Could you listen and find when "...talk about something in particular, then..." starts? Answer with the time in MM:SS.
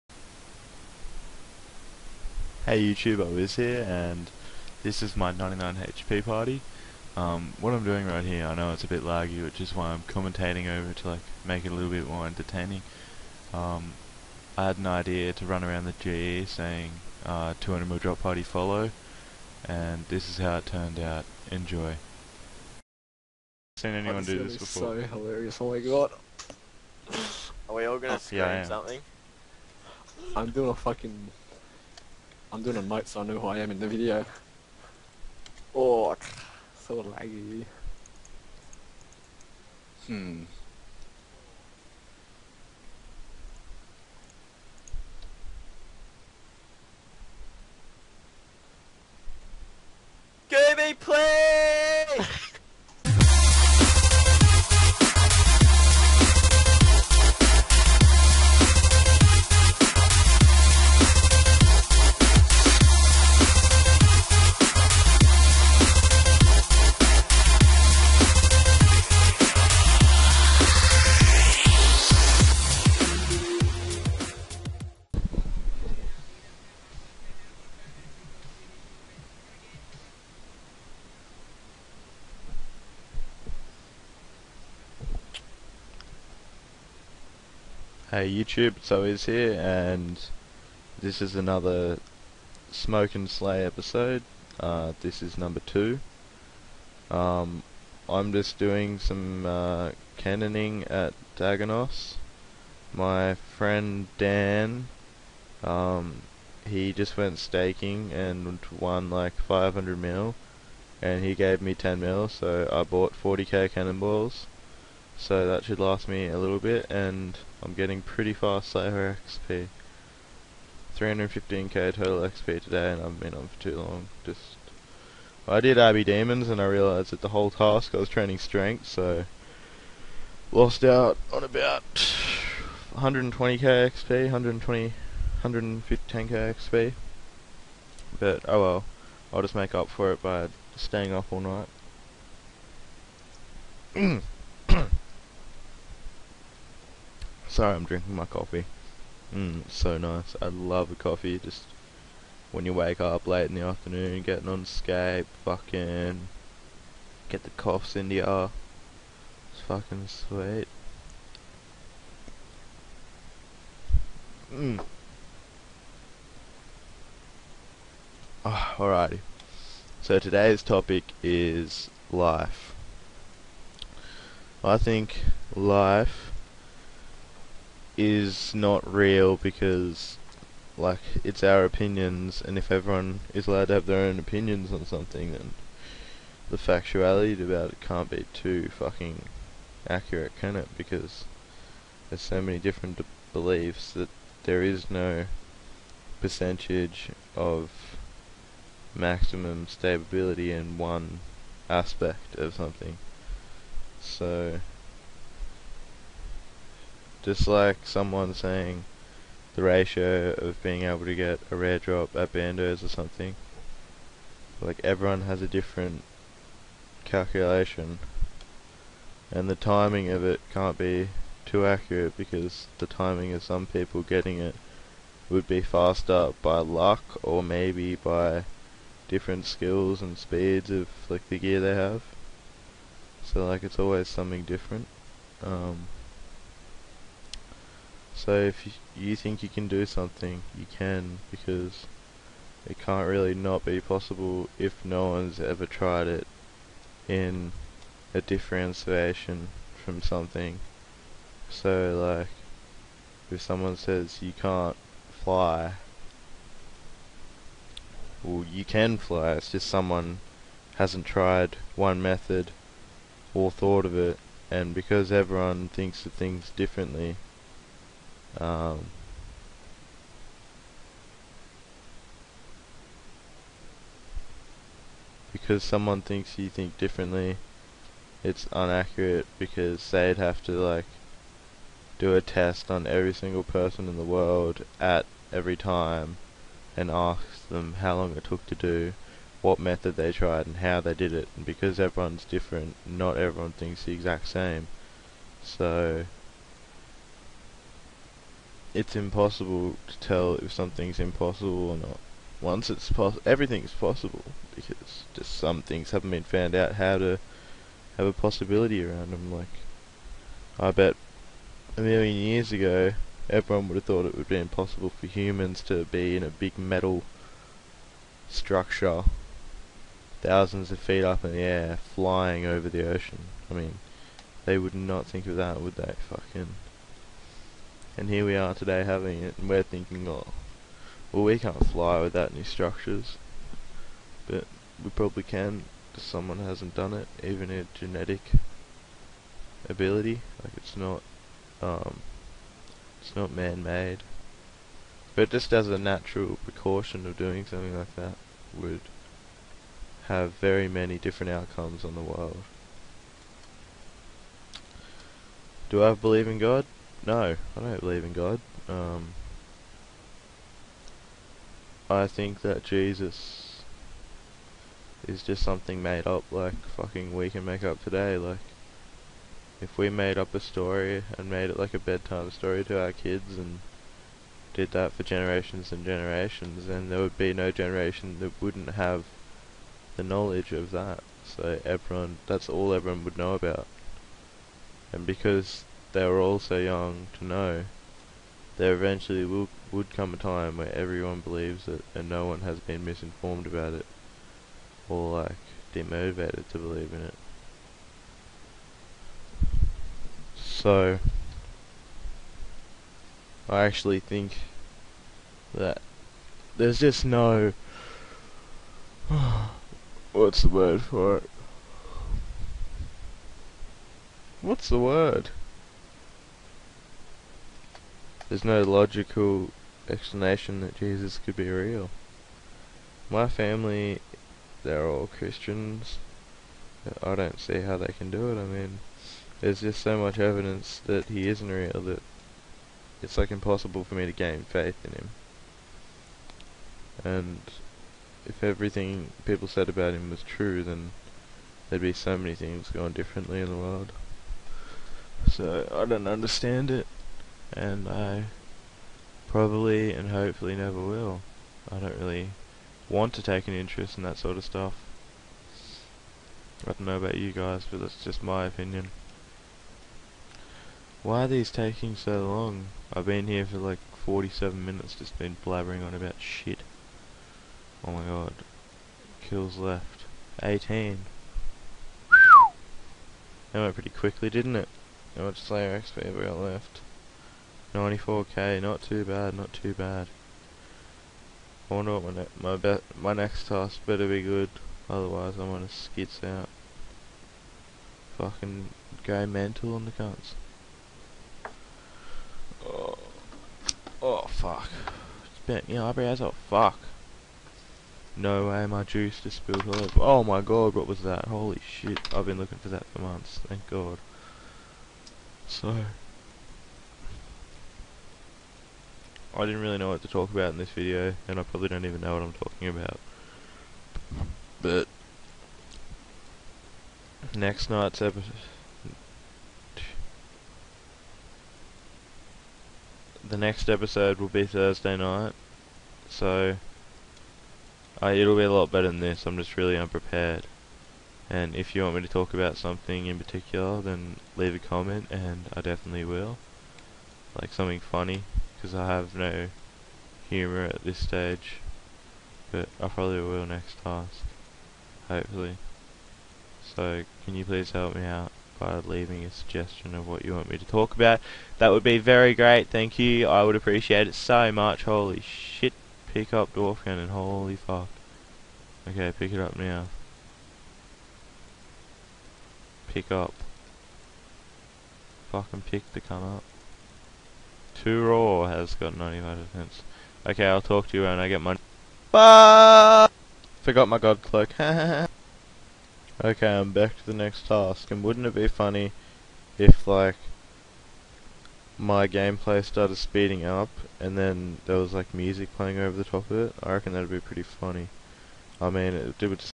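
08:52.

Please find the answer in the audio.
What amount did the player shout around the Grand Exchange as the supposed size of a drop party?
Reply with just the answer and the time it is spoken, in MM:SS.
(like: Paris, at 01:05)
200 mil, at 00:17.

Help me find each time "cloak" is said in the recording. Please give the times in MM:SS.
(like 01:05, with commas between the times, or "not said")
09:34.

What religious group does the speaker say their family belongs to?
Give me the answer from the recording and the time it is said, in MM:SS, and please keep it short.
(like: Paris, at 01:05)
Christians, at 07:05.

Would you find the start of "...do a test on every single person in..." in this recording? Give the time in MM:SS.
04:41.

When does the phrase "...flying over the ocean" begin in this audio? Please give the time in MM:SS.
05:21.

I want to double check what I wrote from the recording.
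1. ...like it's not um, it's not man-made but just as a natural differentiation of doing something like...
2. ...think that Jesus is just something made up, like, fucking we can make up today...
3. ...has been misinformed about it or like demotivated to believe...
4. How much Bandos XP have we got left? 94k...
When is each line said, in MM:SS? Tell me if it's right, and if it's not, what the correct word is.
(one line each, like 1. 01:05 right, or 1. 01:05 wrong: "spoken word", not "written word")
1. 05:40 wrong: "precaution", not "differentiation"
2. 06:02 right
3. 06:32 right
4. 07:55 wrong: "Slayer", not "Bandos".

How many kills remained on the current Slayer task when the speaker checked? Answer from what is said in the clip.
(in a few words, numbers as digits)
18.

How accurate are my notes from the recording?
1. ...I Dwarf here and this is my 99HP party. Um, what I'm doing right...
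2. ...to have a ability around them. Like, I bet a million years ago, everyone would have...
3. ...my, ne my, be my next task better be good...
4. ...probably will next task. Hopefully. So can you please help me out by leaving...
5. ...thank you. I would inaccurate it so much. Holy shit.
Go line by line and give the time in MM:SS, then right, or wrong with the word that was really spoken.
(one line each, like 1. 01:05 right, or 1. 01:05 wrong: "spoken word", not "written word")
1. 00:03 wrong: "Wiz", not "Dwarf"
2. 05:06 wrong: "possibility", not "ability"
3. 08:02 right
4. 09:02 right
5. 09:12 wrong: "appreciate", not "inaccurate".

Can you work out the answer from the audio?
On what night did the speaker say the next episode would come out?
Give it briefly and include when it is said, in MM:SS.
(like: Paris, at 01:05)
Thursday night, at 08:44.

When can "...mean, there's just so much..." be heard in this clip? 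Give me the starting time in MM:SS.
07:08.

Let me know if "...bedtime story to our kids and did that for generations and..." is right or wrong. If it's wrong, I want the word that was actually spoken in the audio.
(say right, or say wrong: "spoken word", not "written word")
right.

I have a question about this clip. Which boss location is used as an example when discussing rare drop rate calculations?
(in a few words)
Bandos.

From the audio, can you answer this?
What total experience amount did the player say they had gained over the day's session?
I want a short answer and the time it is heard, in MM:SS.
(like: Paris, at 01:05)
315k, at 02:00.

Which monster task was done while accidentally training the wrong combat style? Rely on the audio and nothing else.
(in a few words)
Abbey Demons.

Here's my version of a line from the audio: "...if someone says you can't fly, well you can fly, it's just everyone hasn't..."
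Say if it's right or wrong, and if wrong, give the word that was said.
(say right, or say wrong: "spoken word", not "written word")
wrong: "someone", not "everyone".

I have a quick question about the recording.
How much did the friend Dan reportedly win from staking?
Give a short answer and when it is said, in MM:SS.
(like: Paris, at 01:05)
500 mil, at 01:49.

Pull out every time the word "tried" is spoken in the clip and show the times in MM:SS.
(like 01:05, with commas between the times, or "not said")
04:05, 04:21, 04:50.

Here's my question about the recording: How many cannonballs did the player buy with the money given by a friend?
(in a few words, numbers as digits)
40k.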